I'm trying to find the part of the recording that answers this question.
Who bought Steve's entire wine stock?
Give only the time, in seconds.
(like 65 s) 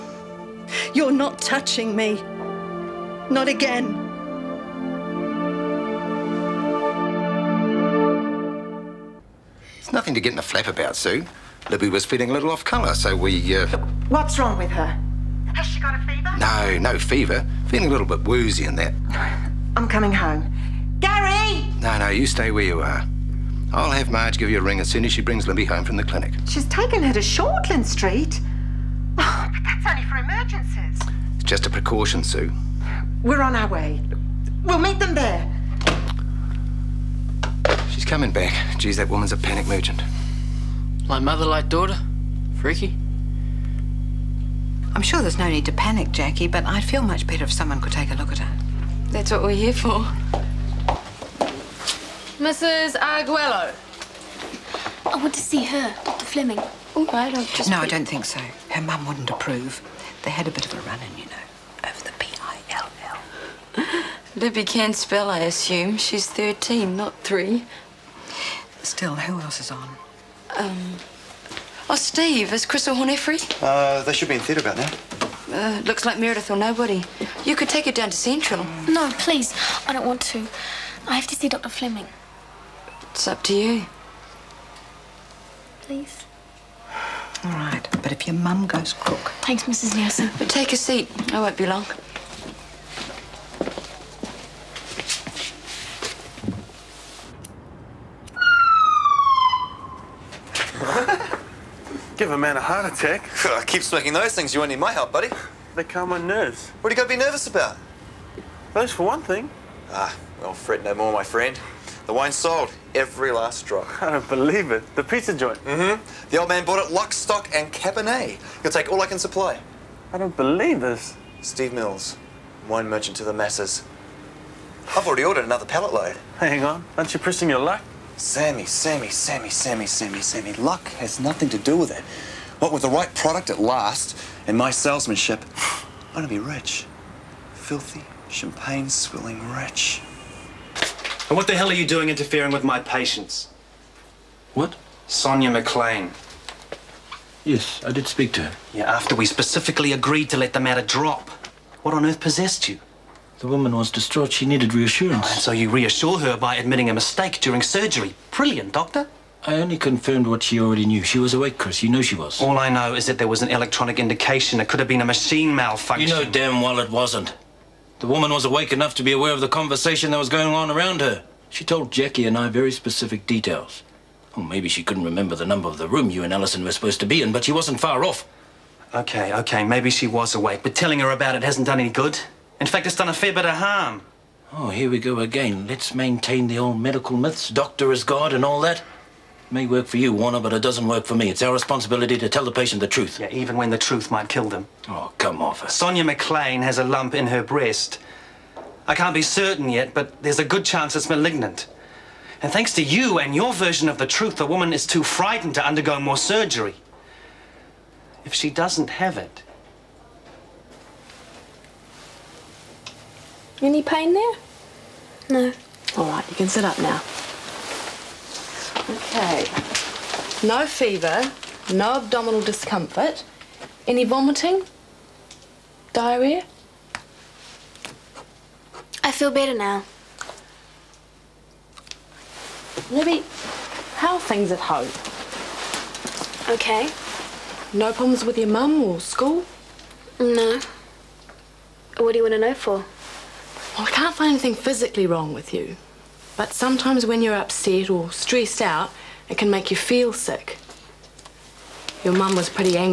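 114 s.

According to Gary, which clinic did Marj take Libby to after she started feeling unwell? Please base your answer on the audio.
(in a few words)
Shortland Street.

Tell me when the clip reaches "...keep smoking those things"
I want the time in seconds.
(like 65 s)
103 s.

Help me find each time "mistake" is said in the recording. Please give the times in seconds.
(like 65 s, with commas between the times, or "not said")
156 s.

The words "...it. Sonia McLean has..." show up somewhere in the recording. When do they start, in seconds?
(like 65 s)
195 s.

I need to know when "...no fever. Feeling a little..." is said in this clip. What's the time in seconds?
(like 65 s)
16 s.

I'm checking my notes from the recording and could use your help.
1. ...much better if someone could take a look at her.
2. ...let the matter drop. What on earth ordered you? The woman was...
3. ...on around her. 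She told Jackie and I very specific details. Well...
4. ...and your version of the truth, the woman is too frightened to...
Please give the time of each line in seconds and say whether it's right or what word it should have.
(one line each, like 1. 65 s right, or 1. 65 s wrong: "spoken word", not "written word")
1. 47 s right
2. 150 s wrong: "possessed", not "ordered"
3. 170 s right
4. 203 s right.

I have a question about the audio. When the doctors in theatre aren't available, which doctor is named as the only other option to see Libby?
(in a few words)
Meredith.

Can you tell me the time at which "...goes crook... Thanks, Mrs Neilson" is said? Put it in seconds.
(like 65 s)
88 s.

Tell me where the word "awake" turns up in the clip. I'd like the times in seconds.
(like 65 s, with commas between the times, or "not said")
161 s, 168 s, 180 s.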